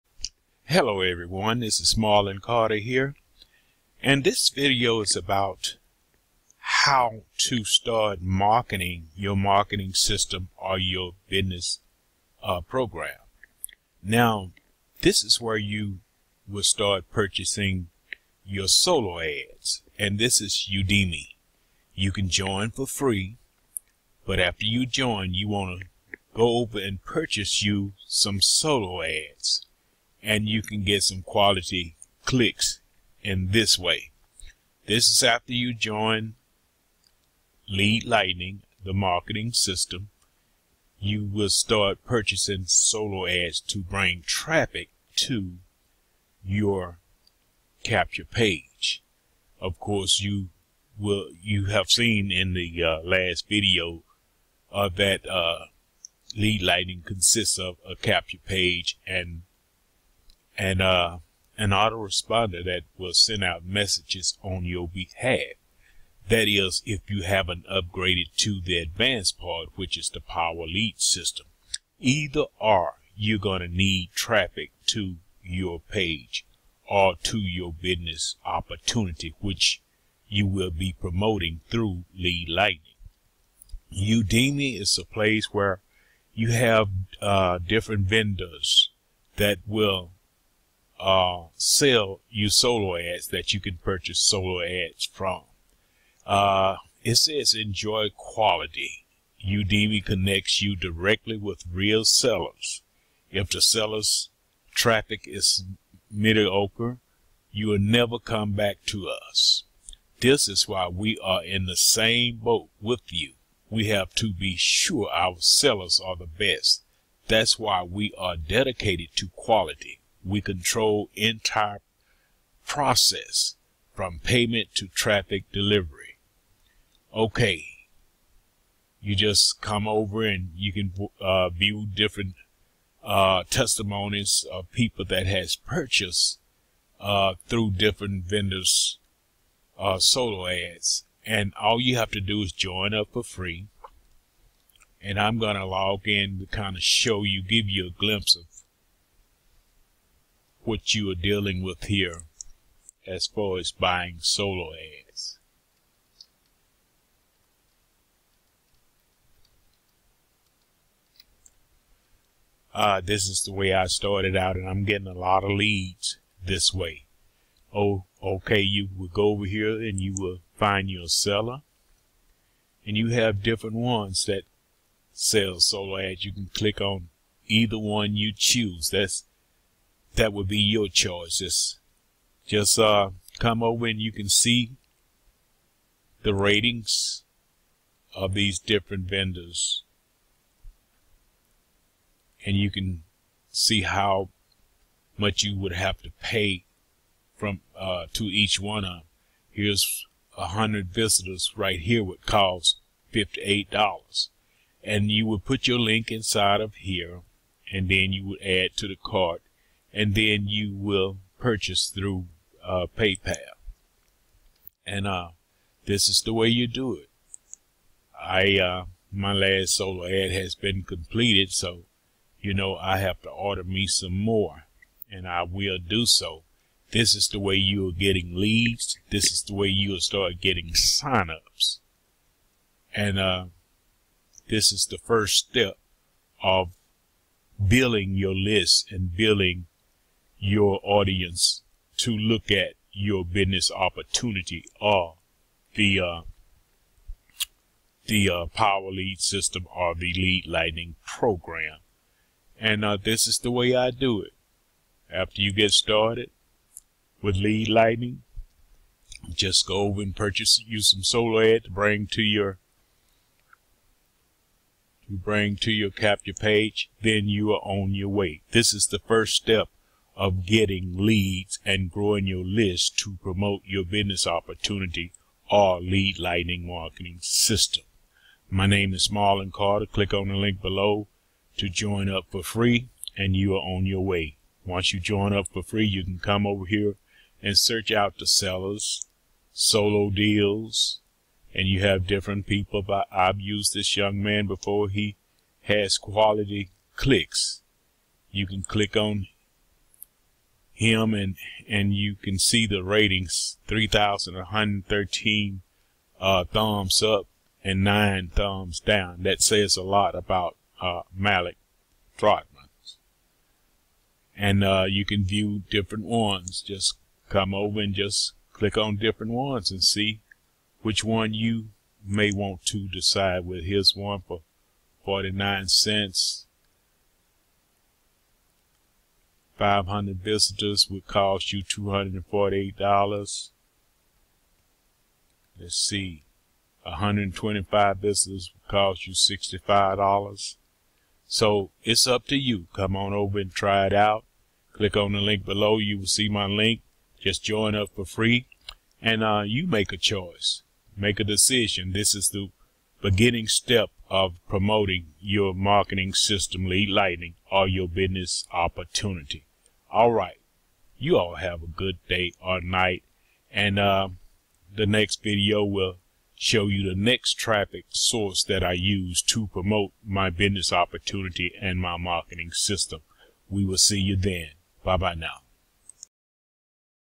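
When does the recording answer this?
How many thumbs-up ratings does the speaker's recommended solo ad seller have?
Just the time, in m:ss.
5:03.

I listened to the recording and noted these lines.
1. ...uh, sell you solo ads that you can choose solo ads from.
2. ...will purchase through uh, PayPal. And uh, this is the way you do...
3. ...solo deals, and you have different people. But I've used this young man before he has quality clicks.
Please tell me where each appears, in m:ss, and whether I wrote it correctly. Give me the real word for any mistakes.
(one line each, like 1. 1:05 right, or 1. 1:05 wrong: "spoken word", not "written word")
1. 1:31 wrong: "purchase", not "choose"
2. 3:30 right
3. 4:49 right.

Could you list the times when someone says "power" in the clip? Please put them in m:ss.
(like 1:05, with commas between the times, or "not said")
1:10, 4:08.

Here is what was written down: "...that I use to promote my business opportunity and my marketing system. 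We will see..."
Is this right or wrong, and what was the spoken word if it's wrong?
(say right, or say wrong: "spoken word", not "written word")
right.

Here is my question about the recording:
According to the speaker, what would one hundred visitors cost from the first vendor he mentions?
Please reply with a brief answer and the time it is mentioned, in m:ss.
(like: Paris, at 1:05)
$58, at 3:23.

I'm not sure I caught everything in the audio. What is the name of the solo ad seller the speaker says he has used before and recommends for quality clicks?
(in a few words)
Malik Trotman.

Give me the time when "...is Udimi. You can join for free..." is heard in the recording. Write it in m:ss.
0:20.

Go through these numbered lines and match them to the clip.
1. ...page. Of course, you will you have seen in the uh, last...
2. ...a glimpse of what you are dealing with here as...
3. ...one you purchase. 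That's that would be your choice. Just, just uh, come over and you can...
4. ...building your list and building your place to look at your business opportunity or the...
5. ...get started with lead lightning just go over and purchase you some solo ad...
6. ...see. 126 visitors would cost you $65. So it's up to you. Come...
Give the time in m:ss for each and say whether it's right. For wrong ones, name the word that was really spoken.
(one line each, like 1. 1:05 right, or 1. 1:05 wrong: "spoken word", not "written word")
1. 0:48 right
2. 2:27 right
3. 2:57 wrong: "choose", not "purchase"
4. 3:57 wrong: "audience", not "place"
5. 4:15 right
6. 5:35 wrong: "125", not "126".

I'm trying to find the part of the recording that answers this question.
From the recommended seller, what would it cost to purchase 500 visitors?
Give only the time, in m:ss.
5:31.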